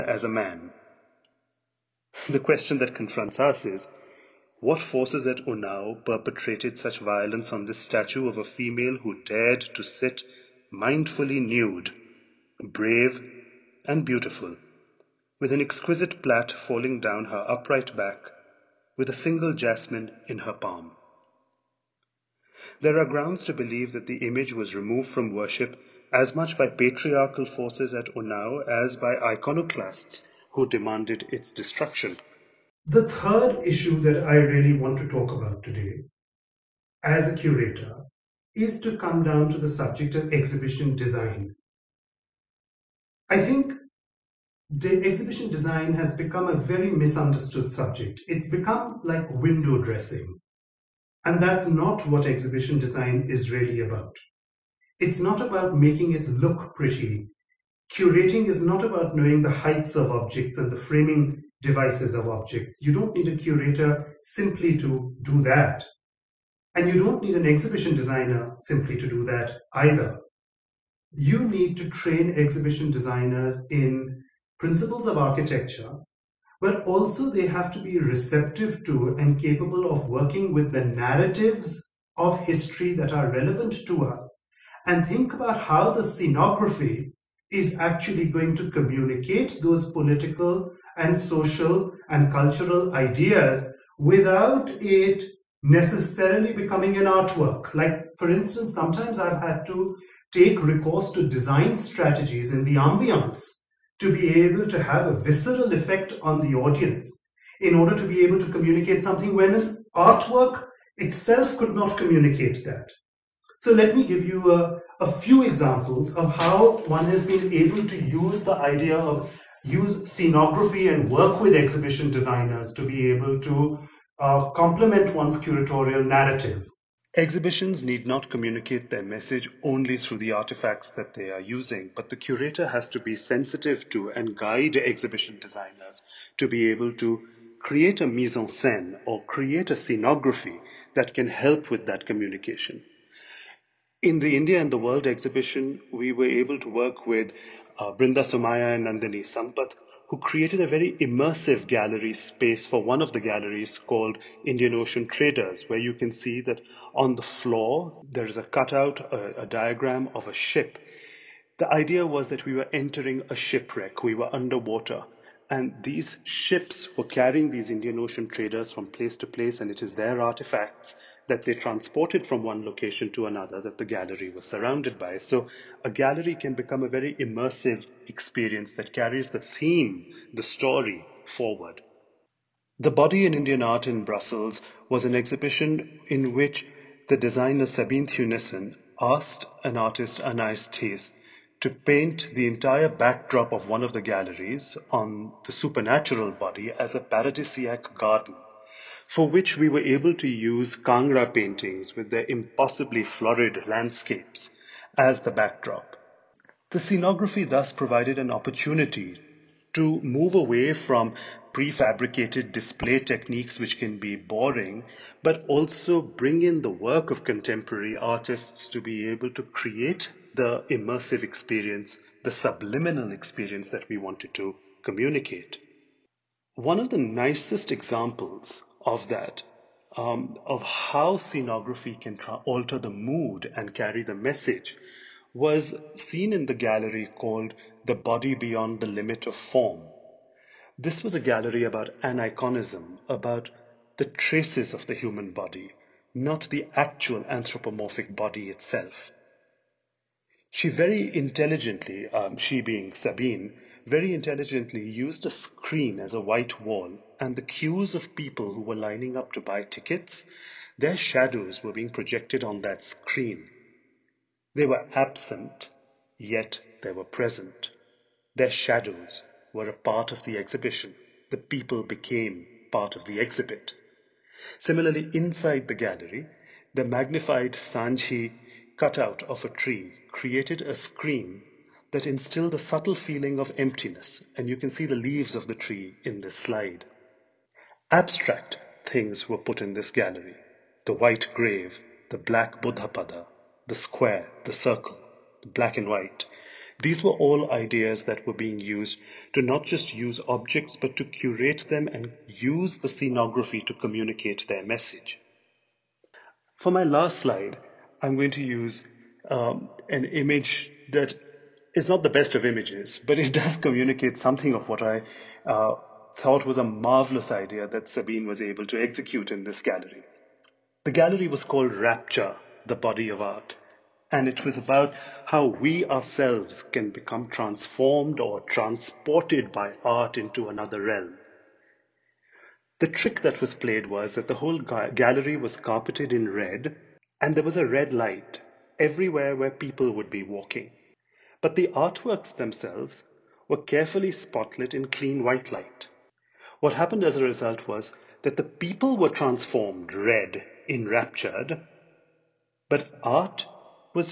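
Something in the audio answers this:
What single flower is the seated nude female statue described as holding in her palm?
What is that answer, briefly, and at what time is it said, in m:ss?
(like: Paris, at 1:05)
jasmine, at 0:19.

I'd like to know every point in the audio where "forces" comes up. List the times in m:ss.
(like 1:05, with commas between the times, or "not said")
0:04, 0:27.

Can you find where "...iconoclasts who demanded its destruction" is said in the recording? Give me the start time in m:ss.
0:29.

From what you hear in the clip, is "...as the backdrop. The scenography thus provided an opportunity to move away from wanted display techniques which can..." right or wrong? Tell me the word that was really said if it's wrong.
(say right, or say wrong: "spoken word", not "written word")
wrong: "prefabricated", not "wanted".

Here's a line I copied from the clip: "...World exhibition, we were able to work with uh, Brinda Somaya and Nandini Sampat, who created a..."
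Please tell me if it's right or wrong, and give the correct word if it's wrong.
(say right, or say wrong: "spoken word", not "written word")
right.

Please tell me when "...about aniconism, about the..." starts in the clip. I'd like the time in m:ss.
4:01.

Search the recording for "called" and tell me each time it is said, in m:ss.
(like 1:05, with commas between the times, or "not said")
2:33, 3:57, 5:21.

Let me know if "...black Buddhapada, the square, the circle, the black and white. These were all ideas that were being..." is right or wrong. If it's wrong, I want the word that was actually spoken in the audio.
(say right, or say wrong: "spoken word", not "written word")
right.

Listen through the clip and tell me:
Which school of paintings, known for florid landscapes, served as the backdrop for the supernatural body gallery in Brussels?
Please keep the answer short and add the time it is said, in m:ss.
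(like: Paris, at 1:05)
Kangra, at 3:20.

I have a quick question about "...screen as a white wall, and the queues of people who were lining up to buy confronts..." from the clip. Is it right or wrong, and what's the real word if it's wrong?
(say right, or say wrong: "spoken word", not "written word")
wrong: "tickets", not "confronts".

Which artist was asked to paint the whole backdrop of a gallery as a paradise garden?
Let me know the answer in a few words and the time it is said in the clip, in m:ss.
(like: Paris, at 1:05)
Anais Thies, at 3:10.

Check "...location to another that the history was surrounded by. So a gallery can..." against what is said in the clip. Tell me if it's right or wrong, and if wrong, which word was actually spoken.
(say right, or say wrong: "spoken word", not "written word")
wrong: "gallery", not "history".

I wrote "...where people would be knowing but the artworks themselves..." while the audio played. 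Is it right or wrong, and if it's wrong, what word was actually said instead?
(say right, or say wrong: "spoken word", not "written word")
wrong: "walking", not "knowing".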